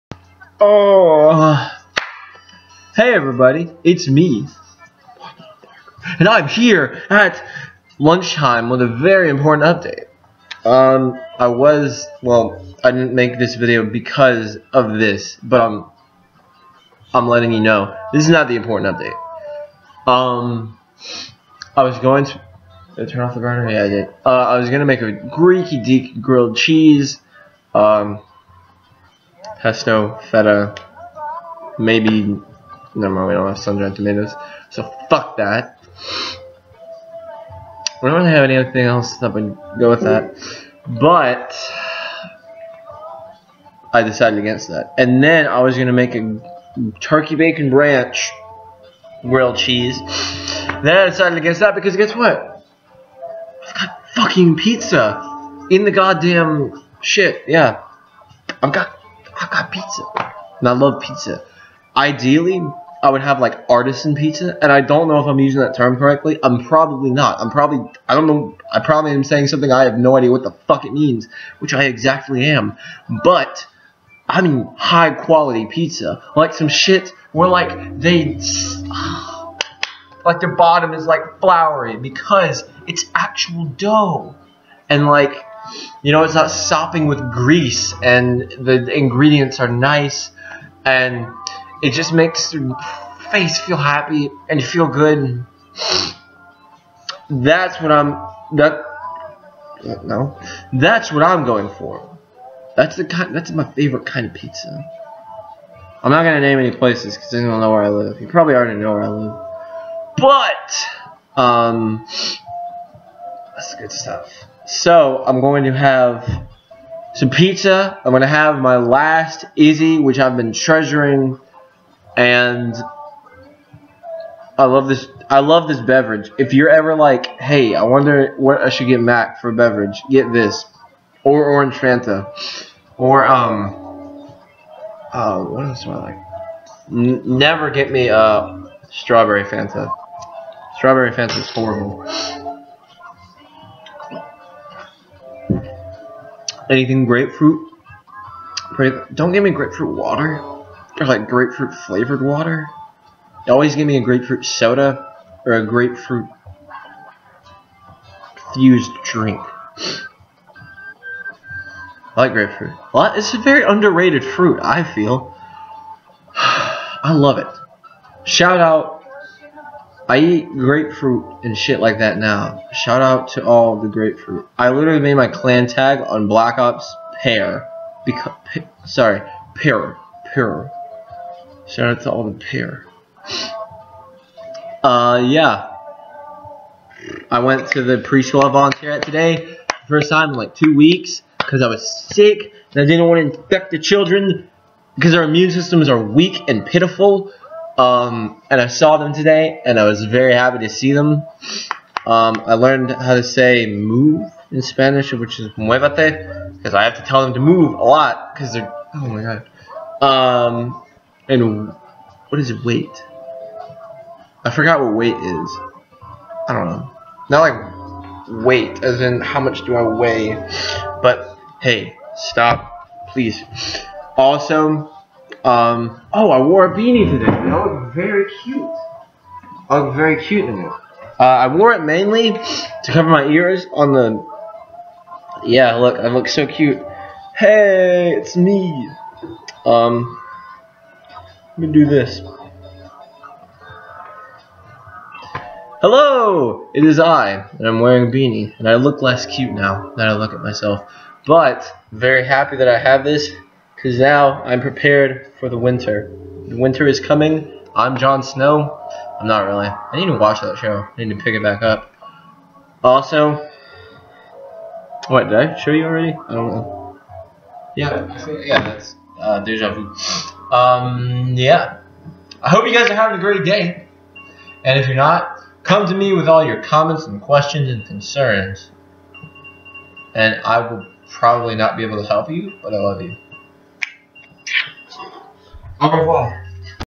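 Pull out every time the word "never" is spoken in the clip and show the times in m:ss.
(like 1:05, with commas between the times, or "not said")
0:32, 2:17.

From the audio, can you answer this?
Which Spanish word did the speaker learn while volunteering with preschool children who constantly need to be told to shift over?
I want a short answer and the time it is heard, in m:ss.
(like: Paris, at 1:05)
muevete, at 3:25.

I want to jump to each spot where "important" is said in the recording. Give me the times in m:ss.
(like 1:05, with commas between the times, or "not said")
0:09, 0:18.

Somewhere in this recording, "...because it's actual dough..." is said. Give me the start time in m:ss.
1:21.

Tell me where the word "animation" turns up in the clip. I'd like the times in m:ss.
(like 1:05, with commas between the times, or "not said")
not said.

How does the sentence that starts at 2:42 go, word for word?
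Well, it's a very underrated fruit, I feel.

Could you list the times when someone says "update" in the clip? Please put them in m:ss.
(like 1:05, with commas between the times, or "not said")
0:09, 0:18.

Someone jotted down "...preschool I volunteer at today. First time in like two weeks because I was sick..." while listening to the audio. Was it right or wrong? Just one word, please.
right.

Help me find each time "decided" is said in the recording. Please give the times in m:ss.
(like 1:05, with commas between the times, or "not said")
0:44, 0:51.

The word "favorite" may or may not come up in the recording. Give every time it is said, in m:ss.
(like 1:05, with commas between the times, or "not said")
1:43.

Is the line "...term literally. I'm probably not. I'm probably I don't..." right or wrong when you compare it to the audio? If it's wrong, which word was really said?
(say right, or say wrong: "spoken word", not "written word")
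wrong: "correctly", not "literally".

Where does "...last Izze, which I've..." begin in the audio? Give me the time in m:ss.
1:58.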